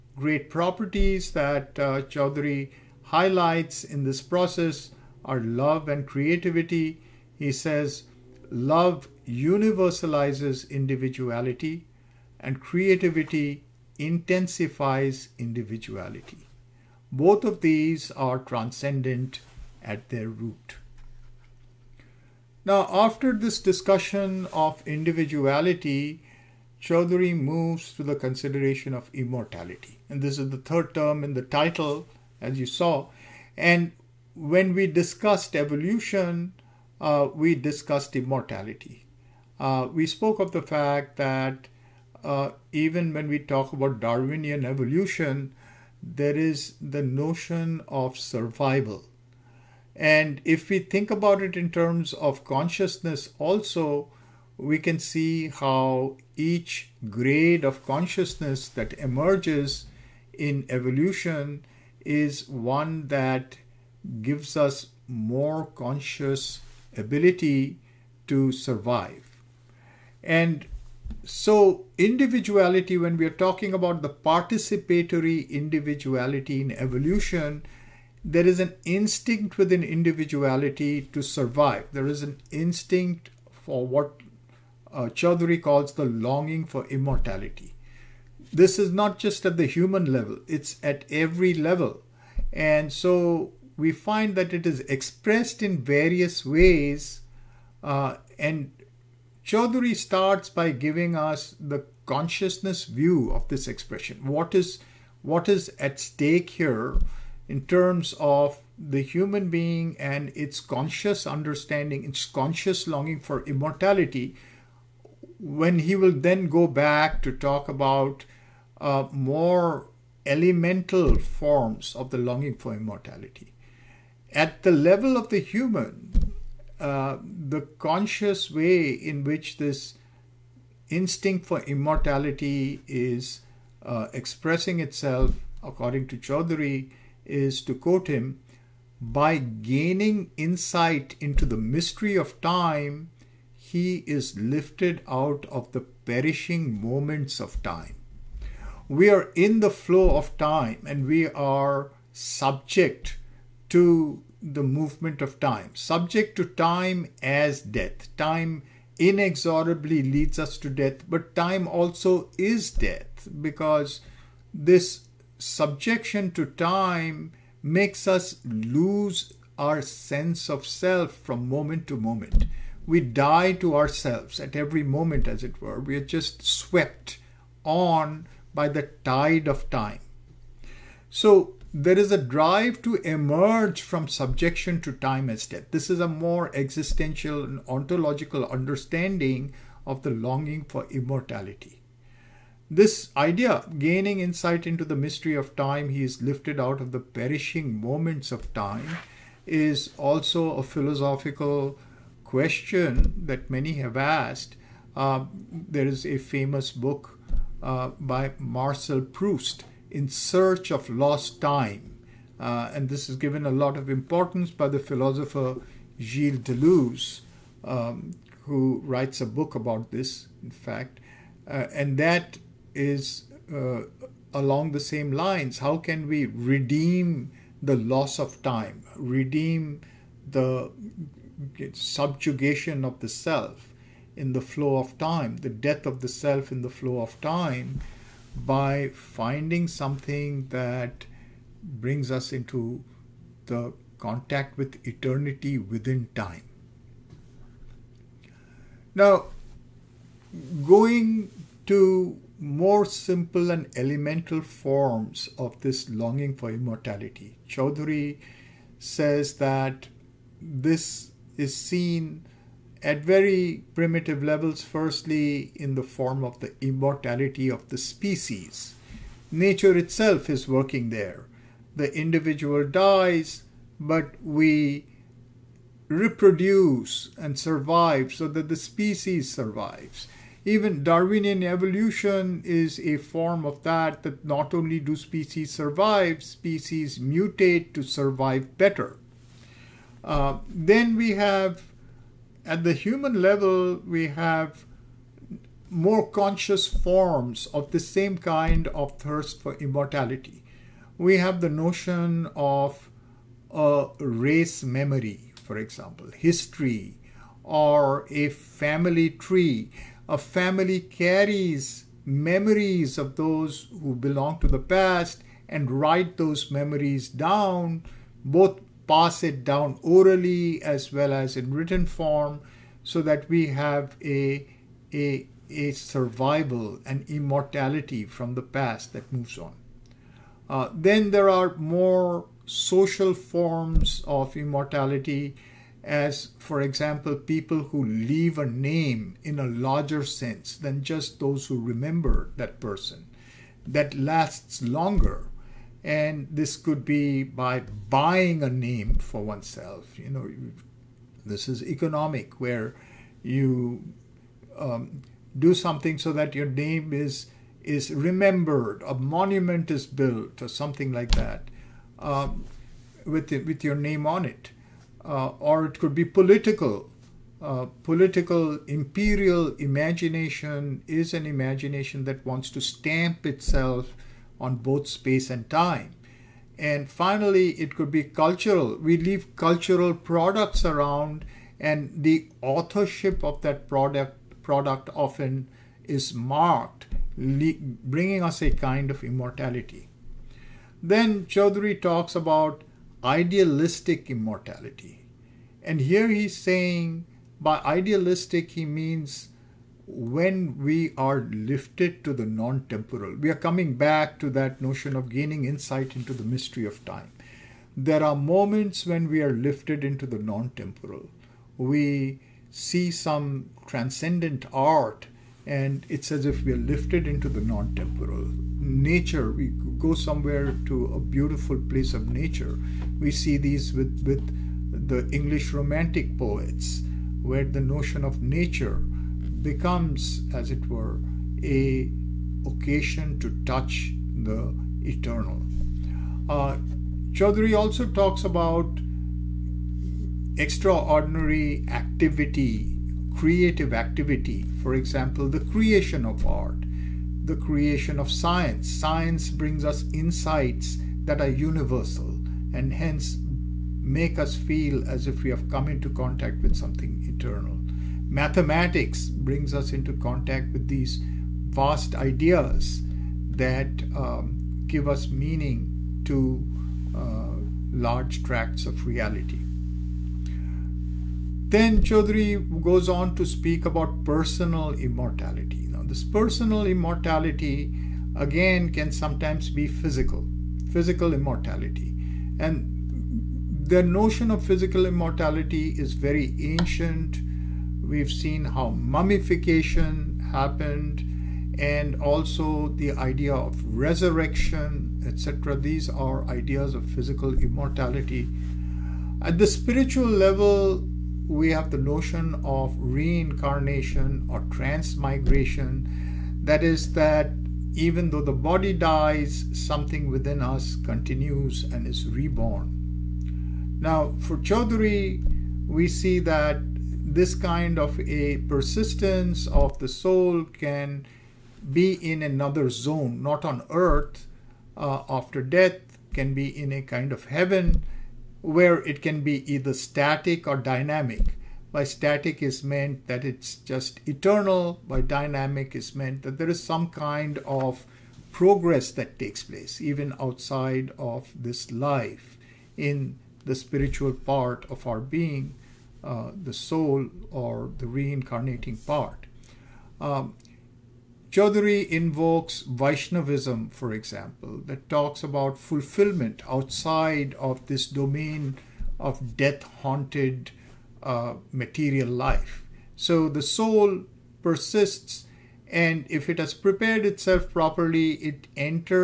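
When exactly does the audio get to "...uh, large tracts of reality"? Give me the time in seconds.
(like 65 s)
466 s.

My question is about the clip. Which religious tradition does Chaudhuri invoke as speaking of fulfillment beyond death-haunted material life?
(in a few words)
Vaishnavism.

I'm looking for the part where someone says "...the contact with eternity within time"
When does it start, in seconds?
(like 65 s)
243 s.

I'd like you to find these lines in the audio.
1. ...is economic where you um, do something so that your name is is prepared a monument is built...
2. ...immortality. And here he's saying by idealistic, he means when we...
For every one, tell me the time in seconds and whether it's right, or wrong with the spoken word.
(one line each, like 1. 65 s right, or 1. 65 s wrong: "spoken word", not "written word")
1. 351 s wrong: "remembered", not "prepared"
2. 394 s right.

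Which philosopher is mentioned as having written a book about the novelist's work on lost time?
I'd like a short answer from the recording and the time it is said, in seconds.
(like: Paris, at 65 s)
Gilles Deleuze, at 215 s.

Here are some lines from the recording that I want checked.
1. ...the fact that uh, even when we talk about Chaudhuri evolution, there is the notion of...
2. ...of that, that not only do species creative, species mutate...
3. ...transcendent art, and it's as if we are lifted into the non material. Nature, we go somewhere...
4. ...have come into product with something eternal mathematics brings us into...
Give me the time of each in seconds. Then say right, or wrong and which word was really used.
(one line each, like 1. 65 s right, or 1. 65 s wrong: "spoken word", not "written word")
1. 40 s wrong: "Darwinian", not "Chaudhuri"
2. 283 s wrong: "survive", not "creative"
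3. 413 s wrong: "temporal", not "material"
4. 455 s wrong: "contact", not "product".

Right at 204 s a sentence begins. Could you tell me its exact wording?
Uh, there is a famous book uh, by Marcel Proust in search of lost time.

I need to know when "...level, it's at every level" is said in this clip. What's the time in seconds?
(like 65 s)
90 s.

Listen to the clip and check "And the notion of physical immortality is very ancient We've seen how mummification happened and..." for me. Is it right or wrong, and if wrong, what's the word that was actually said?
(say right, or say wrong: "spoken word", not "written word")
right.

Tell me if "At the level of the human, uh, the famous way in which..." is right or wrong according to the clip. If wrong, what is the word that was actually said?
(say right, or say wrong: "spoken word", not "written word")
wrong: "conscious", not "famous".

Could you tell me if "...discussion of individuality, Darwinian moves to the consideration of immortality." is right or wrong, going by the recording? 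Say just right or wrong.
wrong.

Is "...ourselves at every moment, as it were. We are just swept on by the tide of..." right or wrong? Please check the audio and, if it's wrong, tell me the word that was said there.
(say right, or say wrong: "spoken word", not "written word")
right.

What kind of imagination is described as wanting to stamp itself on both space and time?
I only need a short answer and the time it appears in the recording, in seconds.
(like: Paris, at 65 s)
Imperial imagination, at 368 s.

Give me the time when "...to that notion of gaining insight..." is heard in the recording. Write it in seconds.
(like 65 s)
404 s.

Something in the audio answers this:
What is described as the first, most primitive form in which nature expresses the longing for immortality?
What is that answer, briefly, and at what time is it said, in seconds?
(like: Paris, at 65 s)
Immortality of the species, at 266 s.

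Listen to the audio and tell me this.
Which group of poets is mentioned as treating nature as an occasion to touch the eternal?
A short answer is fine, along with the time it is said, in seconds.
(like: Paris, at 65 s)
English Romantic poets, at 425 s.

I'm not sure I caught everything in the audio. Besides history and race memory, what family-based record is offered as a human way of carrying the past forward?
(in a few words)
A family tree.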